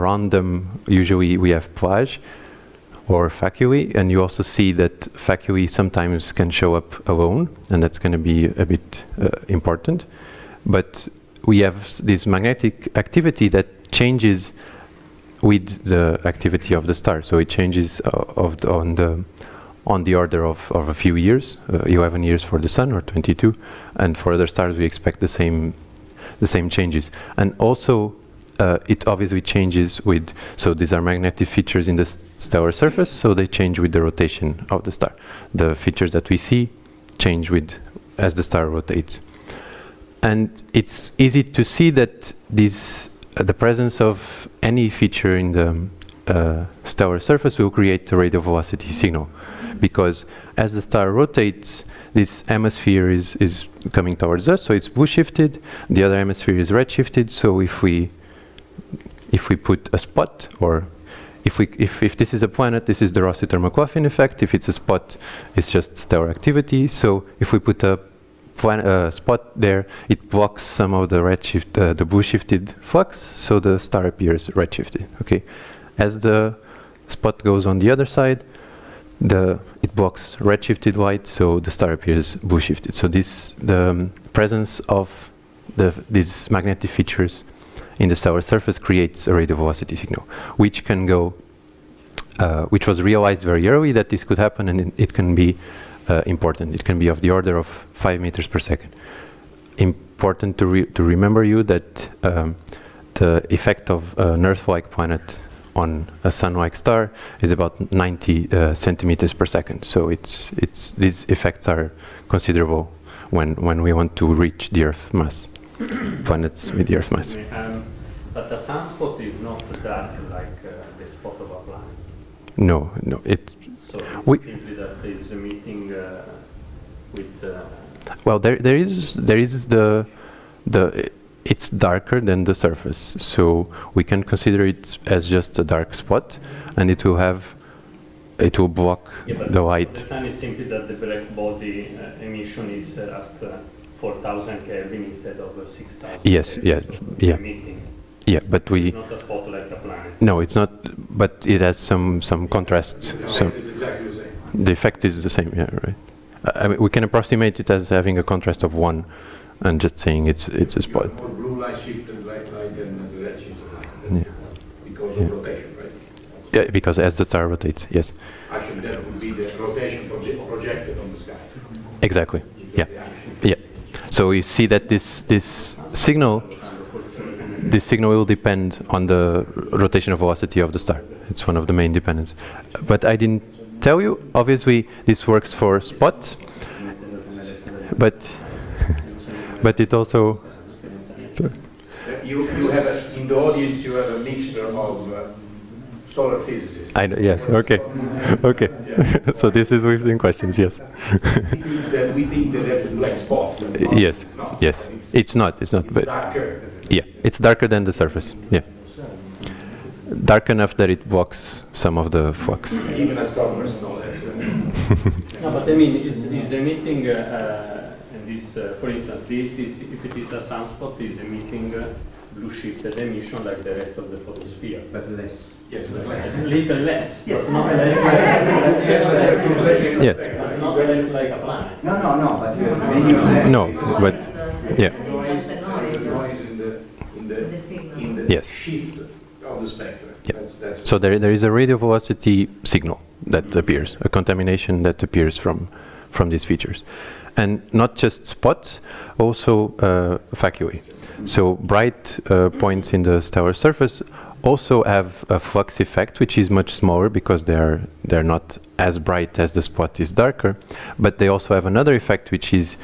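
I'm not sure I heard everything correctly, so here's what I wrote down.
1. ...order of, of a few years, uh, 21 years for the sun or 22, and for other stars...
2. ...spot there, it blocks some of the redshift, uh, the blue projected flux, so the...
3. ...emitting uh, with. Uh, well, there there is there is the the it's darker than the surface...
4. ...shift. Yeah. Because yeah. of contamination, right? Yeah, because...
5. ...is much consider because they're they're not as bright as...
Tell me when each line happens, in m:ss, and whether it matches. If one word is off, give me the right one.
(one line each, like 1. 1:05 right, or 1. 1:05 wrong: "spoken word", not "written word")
1. 0:20 wrong: "11", not "21"
2. 1:09 wrong: "shifted", not "projected"
3. 2:05 right
4. 2:43 wrong: "rotation", not "contamination"
5. 4:16 wrong: "smaller", not "consider".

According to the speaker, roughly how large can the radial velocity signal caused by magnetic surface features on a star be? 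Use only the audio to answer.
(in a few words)
5 meters per second.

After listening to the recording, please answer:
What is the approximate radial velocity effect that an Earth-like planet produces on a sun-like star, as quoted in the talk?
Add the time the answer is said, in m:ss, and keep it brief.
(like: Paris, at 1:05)
90 centimeters per second, at 1:47.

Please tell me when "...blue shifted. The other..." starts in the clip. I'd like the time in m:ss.
0:54.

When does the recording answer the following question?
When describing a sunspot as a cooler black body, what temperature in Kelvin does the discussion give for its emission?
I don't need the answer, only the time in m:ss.
2:23.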